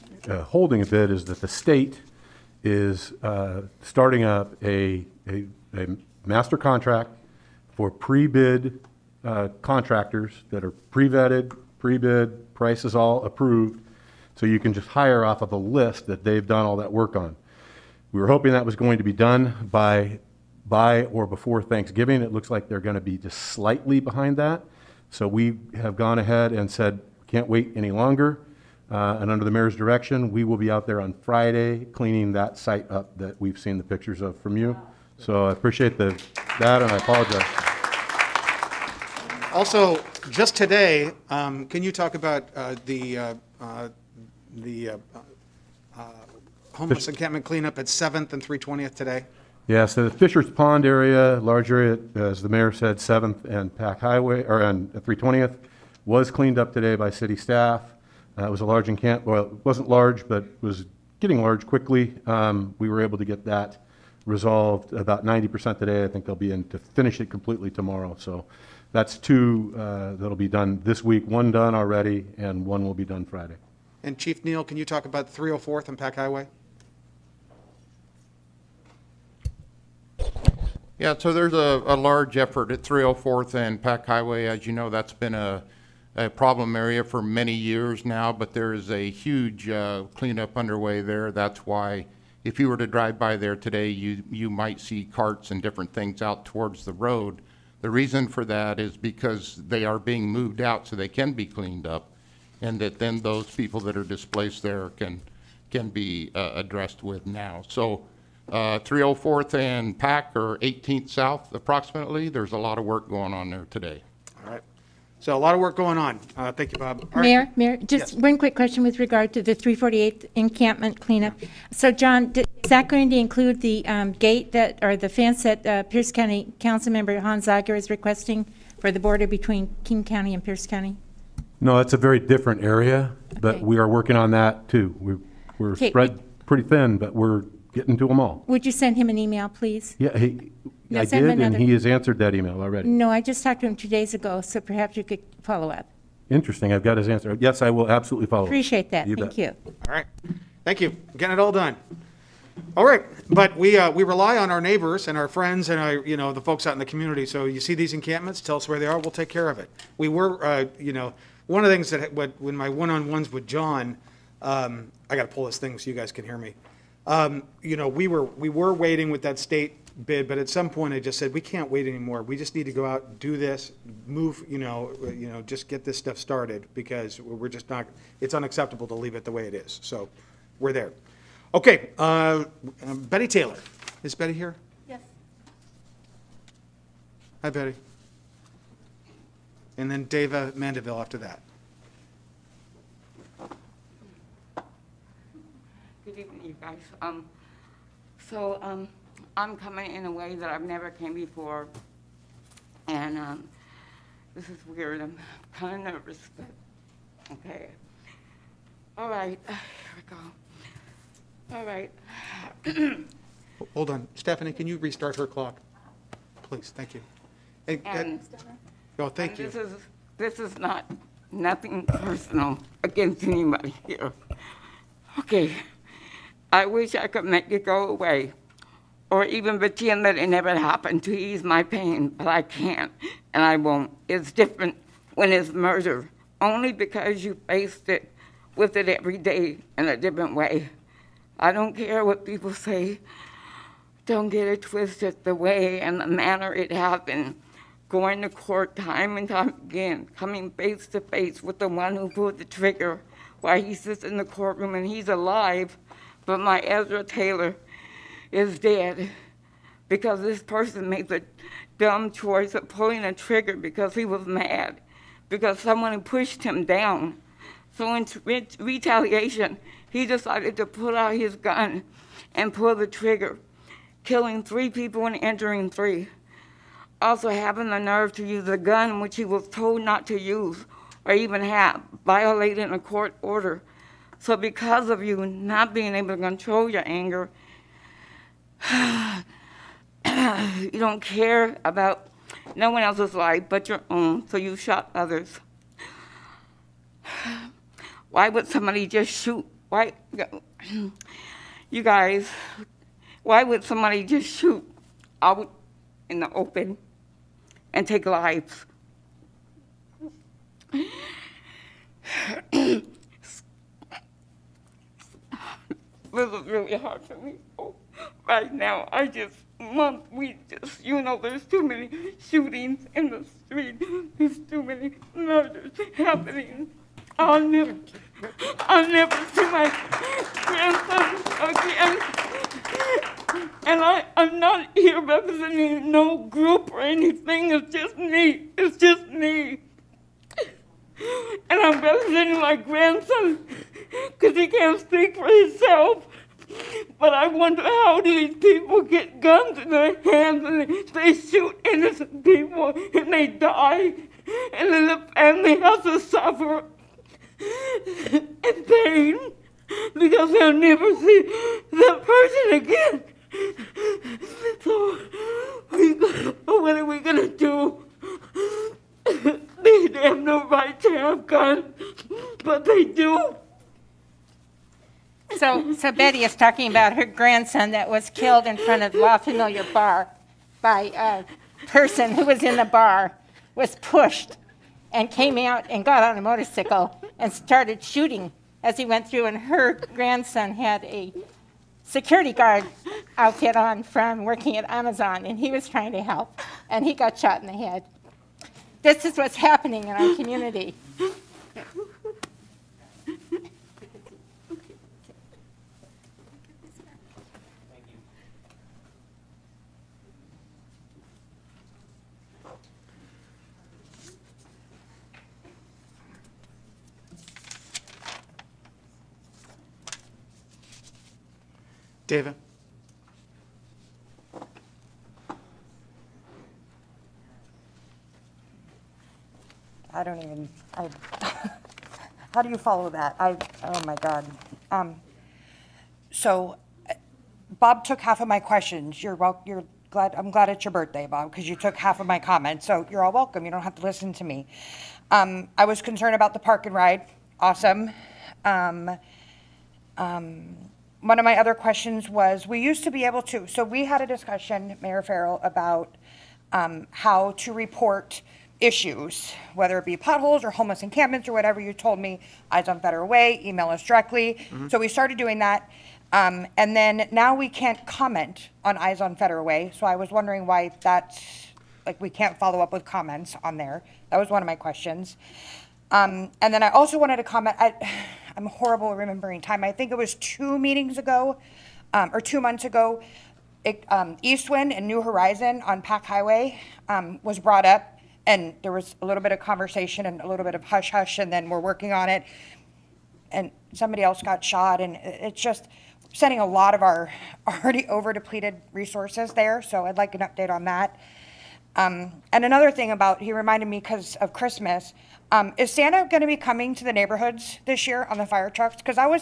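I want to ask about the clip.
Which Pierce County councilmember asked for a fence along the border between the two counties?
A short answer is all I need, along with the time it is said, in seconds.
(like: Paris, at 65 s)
Hans Zeiger, at 127 s.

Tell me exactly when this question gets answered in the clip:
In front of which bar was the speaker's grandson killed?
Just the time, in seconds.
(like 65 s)
378 s.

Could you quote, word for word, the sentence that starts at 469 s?
So I was wondering why that's, like, we can't follow up with comments on there.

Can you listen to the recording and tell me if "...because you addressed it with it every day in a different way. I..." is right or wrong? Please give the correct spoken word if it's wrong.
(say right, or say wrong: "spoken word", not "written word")
wrong: "faced", not "addressed".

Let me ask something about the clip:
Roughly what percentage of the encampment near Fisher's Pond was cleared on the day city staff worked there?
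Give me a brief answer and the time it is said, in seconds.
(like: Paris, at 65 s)
90%, at 65 s.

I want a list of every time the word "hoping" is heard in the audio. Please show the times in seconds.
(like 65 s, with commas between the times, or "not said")
18 s.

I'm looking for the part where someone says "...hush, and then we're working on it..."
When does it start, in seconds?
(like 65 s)
490 s.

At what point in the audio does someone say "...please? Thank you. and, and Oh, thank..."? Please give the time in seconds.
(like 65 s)
216 s.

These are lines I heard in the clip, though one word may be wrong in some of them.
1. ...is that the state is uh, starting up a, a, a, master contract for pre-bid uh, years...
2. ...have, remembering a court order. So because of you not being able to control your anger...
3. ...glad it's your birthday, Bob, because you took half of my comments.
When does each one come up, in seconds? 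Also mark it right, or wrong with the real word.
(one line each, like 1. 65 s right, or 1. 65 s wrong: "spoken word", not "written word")
1. 1 s wrong: "contractors", not "years"
2. 281 s wrong: "violating", not "remembering"
3. 440 s right.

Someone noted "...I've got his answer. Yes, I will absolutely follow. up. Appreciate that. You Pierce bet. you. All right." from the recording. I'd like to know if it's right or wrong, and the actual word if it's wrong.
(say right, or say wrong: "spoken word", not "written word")
wrong: "Thank", not "Pierce".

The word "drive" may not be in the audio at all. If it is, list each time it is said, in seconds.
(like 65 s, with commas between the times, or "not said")
92 s.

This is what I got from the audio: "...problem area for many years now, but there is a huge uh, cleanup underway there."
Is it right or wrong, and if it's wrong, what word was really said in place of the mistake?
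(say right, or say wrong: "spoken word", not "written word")
right.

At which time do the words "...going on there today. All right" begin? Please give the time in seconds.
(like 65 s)
113 s.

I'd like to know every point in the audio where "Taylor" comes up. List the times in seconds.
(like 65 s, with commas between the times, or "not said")
183 s, 257 s.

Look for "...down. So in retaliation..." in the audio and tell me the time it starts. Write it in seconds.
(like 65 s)
266 s.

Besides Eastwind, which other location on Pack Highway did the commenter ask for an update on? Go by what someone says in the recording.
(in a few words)
New Horizon.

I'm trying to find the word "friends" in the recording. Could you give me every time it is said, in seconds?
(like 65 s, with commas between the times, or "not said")
155 s.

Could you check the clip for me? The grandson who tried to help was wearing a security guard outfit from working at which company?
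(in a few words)
Amazon.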